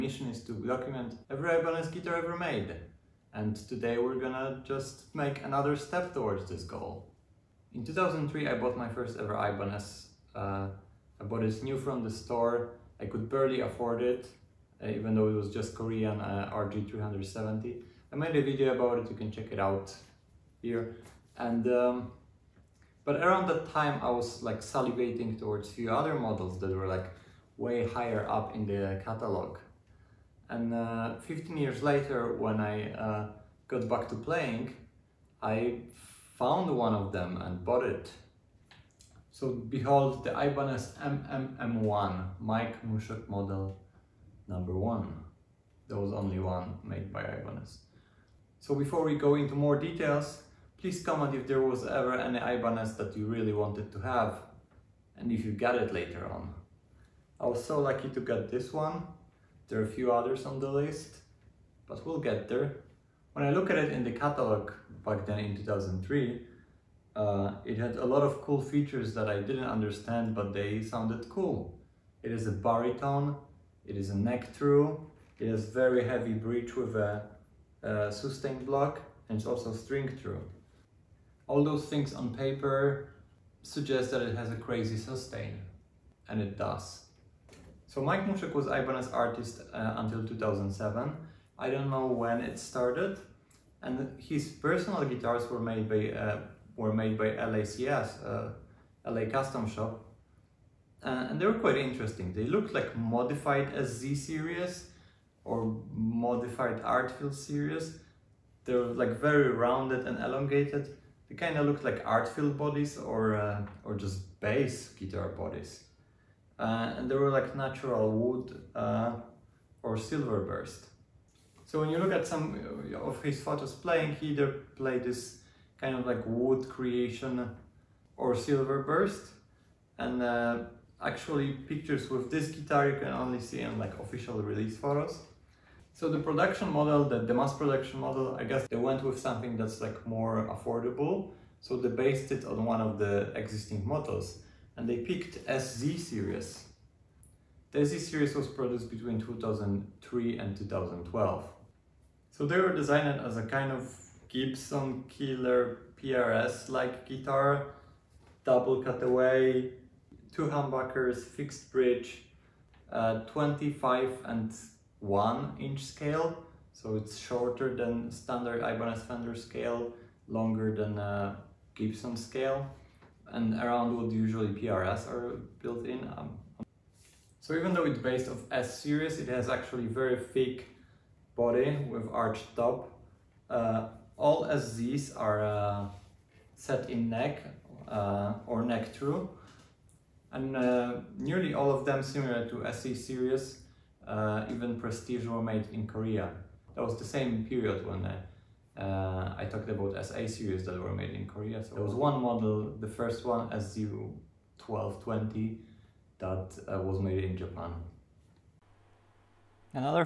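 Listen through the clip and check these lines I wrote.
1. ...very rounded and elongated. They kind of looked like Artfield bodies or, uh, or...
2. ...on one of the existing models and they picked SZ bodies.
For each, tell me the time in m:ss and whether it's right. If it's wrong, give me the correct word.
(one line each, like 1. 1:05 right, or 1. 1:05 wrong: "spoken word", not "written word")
1. 1:49 right
2. 2:22 wrong: "series", not "bodies".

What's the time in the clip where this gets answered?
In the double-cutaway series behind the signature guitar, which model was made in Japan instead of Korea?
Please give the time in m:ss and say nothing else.
3:23.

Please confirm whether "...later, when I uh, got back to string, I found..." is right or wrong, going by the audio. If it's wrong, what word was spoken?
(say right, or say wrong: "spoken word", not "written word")
wrong: "playing", not "string".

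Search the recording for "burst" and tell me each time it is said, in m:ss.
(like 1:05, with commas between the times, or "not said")
2:00, 2:08.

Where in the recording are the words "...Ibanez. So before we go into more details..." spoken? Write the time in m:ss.
0:47.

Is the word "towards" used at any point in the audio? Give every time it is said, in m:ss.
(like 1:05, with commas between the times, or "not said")
0:06, 0:25.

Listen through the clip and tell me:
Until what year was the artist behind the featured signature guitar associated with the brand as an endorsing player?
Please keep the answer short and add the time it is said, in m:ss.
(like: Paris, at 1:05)
2007, at 1:30.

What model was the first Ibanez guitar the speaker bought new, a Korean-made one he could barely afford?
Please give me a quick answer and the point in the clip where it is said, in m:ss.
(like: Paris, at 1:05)
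RG370, at 0:16.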